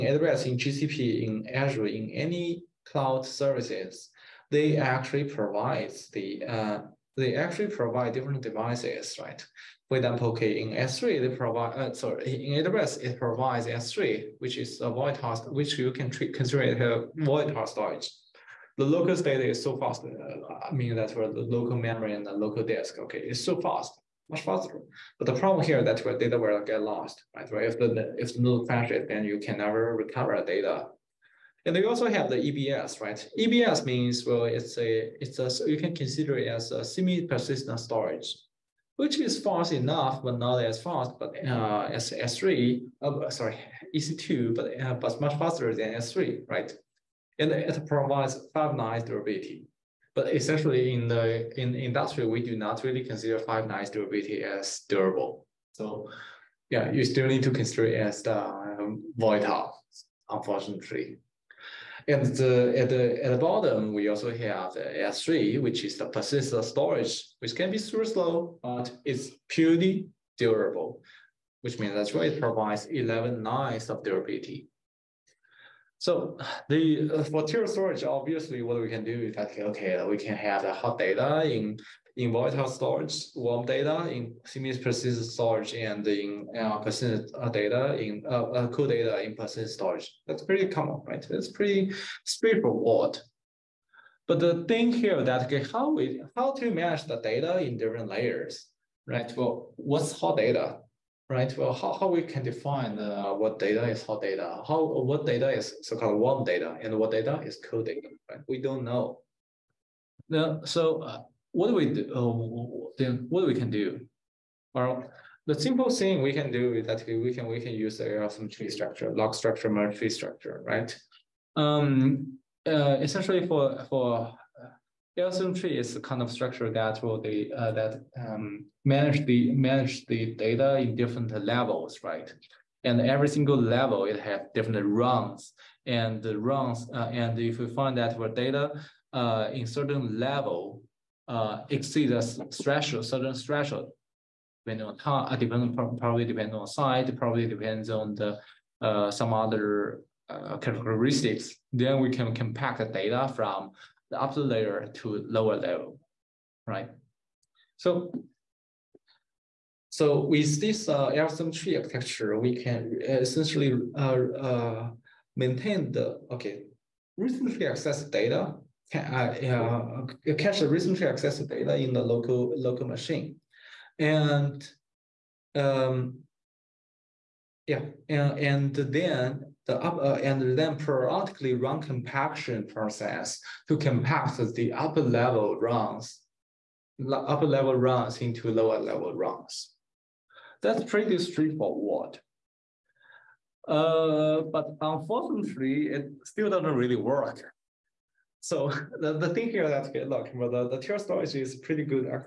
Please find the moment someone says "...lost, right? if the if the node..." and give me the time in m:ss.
0:26.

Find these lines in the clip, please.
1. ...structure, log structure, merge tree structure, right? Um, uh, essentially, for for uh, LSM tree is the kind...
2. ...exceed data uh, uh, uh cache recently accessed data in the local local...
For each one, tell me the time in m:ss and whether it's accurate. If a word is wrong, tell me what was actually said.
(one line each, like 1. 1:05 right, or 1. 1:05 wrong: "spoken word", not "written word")
1. 1:58 right
2. 2:47 wrong: "accessed", not "exceed".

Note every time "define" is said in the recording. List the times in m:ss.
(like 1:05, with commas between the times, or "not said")
1:42.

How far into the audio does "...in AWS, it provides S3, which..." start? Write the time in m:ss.
0:12.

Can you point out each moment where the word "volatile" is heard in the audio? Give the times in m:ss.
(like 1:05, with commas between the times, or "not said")
0:59, 1:22.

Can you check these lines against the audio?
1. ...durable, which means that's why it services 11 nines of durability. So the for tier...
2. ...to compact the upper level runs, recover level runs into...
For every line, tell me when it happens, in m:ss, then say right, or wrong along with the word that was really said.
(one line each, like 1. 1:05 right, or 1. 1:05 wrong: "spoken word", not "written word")
1. 1:10 wrong: "provides", not "services"
2. 3:03 wrong: "upper", not "recover".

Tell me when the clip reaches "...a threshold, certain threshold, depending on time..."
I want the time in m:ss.
2:22.